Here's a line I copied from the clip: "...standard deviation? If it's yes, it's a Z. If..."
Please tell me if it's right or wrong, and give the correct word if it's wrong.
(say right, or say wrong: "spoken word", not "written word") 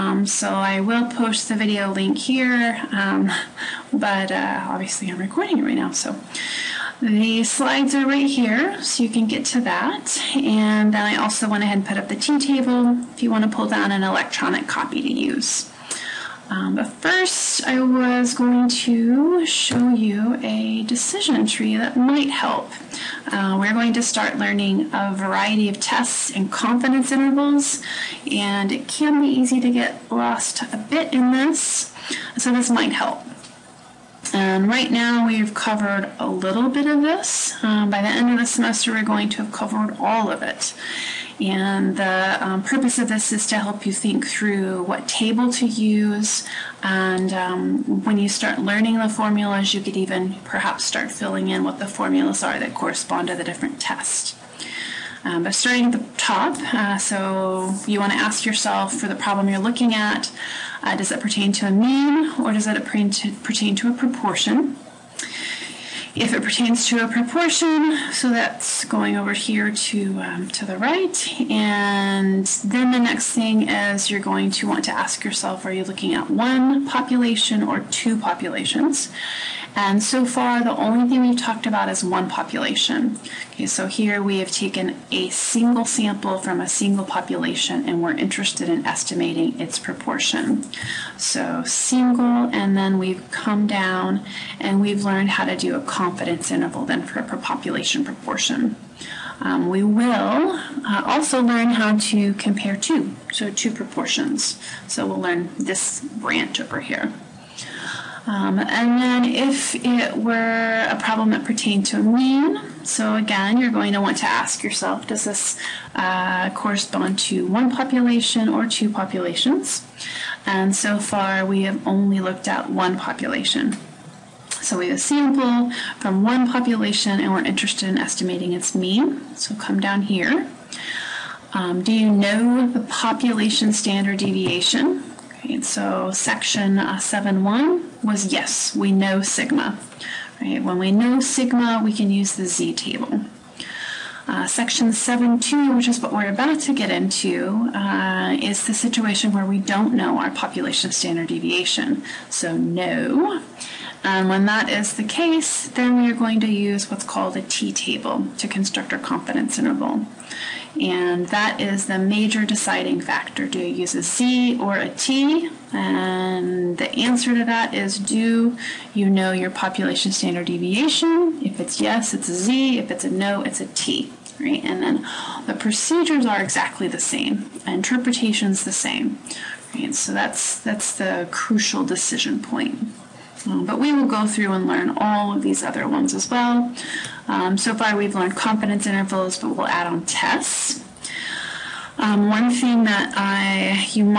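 right.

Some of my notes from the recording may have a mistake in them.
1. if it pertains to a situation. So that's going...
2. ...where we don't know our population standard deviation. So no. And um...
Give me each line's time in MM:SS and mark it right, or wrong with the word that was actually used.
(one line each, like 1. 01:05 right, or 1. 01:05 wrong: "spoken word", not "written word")
1. 01:06 wrong: "proportion", not "situation"
2. 02:29 right.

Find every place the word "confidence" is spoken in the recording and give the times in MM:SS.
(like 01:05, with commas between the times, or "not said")
00:26, 01:35, 02:38, 03:08.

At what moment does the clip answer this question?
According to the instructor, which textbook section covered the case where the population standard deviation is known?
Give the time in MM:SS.
02:16.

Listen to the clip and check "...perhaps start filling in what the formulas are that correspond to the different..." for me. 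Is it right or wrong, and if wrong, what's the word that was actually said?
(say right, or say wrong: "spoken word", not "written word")
right.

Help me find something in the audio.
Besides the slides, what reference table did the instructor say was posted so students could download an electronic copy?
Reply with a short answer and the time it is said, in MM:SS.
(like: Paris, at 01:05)
T table, at 00:12.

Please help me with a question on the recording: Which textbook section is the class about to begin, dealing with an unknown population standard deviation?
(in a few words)
7.2.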